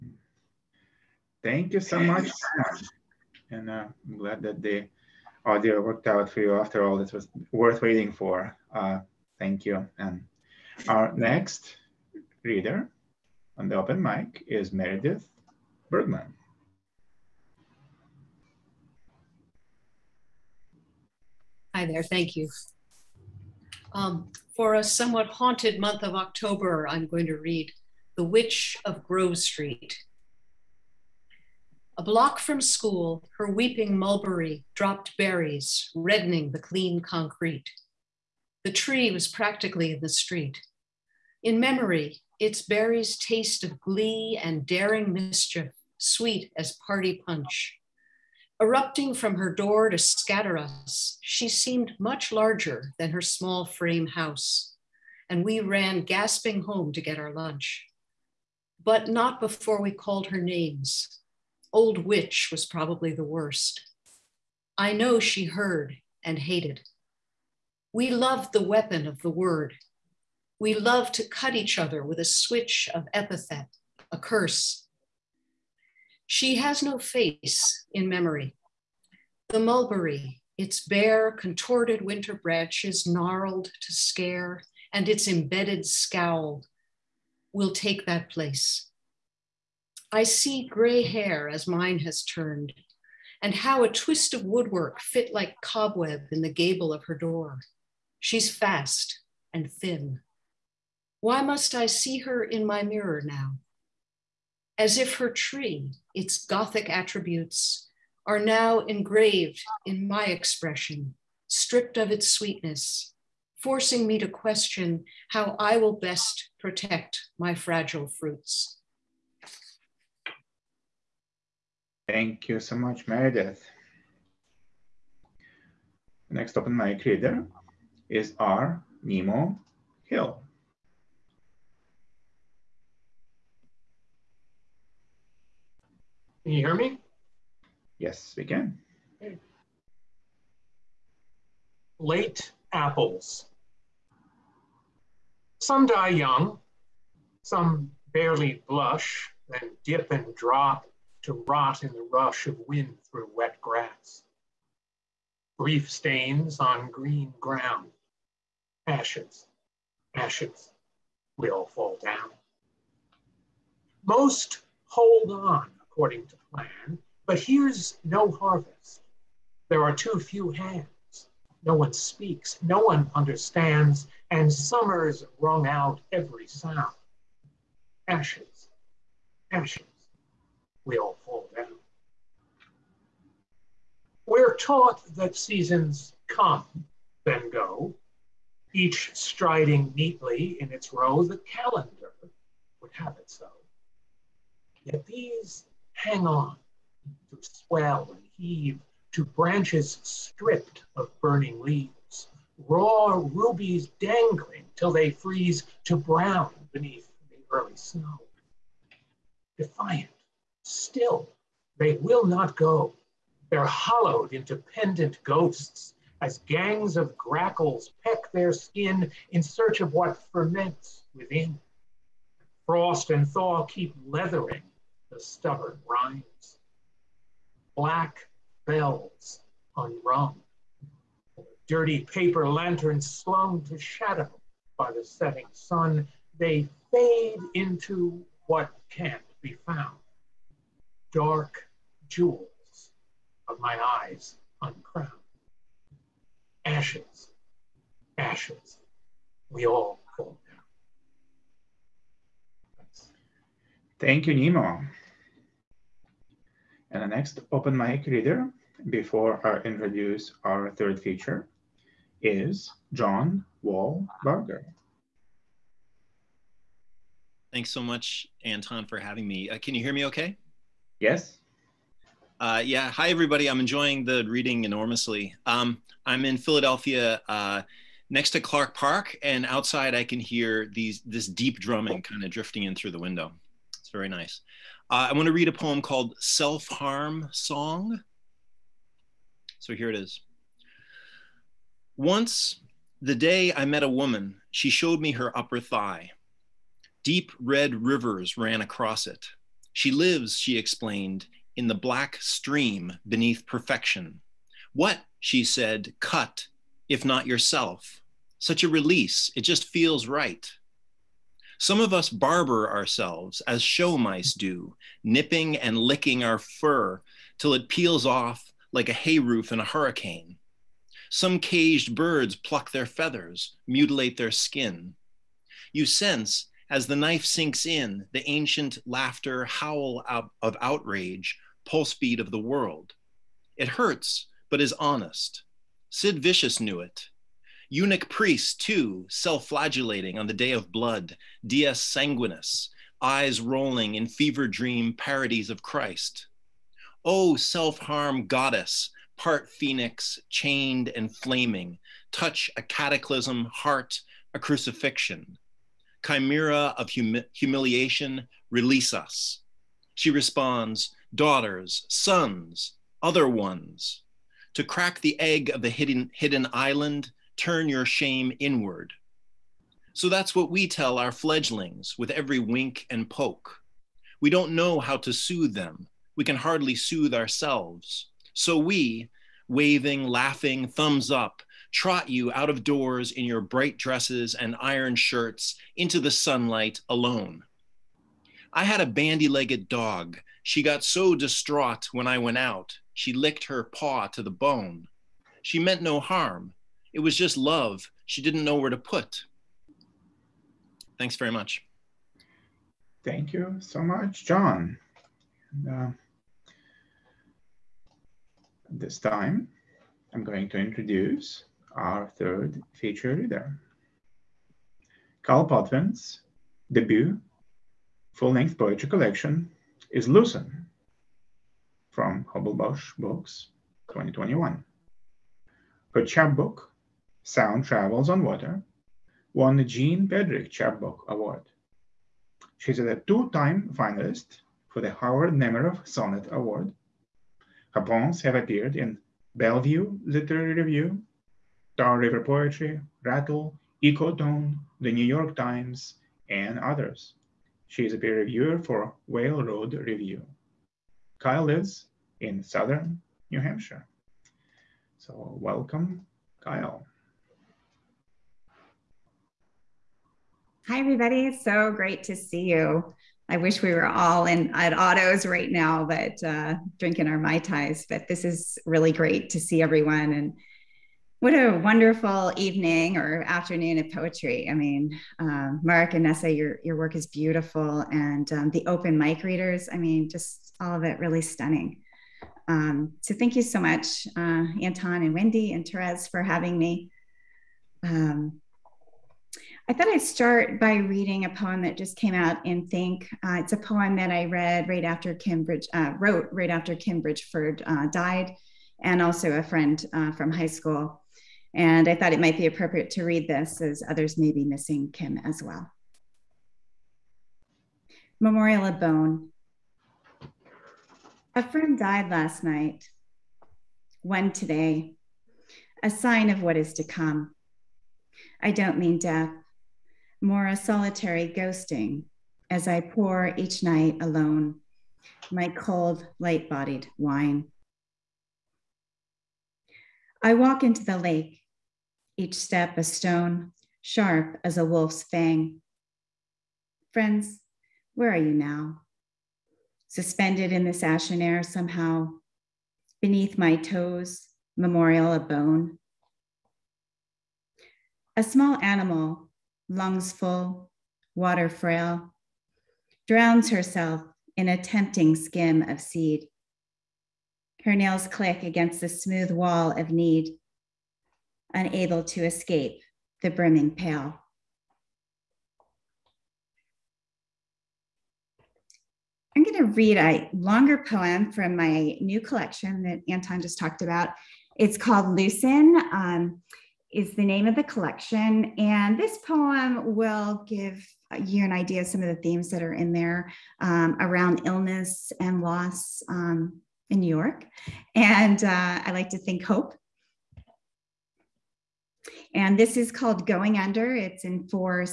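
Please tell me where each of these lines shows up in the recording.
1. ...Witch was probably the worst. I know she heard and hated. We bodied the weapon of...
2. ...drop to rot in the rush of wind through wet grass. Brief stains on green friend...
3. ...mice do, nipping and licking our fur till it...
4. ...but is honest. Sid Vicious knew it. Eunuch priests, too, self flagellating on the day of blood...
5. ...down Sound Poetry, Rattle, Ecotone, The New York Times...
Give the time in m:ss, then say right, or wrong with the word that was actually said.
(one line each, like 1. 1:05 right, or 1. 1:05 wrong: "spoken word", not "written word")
1. 1:02 wrong: "loved", not "bodied"
2. 2:30 wrong: "ground", not "friend"
3. 5:13 right
4. 5:34 right
5. 7:21 wrong: "River", not "Sound".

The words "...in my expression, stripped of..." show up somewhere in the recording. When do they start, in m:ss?
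1:49.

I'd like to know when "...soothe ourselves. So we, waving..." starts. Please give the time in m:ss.
6:16.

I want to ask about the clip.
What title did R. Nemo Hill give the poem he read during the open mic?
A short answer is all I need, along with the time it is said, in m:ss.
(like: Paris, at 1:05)
Late Apples, at 2:21.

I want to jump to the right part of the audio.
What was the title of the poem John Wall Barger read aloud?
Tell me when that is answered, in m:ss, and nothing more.
4:46.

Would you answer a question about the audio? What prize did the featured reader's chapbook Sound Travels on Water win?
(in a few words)
Jean Pedrick Chapbook Award.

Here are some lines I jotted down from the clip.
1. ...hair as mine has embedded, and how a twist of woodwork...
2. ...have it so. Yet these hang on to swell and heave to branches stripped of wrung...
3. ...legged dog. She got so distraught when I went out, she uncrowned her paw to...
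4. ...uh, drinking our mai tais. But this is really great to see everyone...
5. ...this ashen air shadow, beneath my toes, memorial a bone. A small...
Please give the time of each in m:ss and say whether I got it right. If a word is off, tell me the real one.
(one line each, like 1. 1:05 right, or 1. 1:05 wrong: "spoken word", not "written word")
1. 1:31 wrong: "turned", not "embedded"
2. 3:12 wrong: "burning", not "wrung"
3. 6:29 wrong: "licked", not "uncrowned"
4. 7:46 right
5. 9:00 wrong: "somehow", not "shadow".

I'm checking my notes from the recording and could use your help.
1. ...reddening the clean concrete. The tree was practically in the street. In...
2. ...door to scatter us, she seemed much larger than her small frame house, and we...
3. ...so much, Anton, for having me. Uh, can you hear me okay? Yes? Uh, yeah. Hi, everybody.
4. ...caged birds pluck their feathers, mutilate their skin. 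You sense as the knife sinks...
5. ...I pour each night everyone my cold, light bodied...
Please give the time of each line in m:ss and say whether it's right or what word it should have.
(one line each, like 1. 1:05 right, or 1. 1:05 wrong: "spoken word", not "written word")
1. 0:35 right
2. 0:49 right
3. 4:27 right
4. 5:21 right
5. 8:42 wrong: "alone", not "everyone".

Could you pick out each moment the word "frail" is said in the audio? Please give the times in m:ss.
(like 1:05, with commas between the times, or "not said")
9:11.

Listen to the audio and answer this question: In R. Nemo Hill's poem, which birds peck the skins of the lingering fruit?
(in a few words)
grackles.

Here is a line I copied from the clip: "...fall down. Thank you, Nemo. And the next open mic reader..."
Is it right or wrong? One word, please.
right.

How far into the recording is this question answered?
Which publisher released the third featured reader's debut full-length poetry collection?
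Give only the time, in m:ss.
7:02.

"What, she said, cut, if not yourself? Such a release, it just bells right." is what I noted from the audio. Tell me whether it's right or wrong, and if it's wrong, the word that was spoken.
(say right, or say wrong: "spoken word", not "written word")
wrong: "feels", not "bells".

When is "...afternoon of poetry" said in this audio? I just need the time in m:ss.
7:53.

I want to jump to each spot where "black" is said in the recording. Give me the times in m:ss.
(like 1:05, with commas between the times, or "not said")
3:47, 5:01.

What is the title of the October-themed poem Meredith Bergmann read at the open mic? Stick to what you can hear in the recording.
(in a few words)
The Witch of Grove Street.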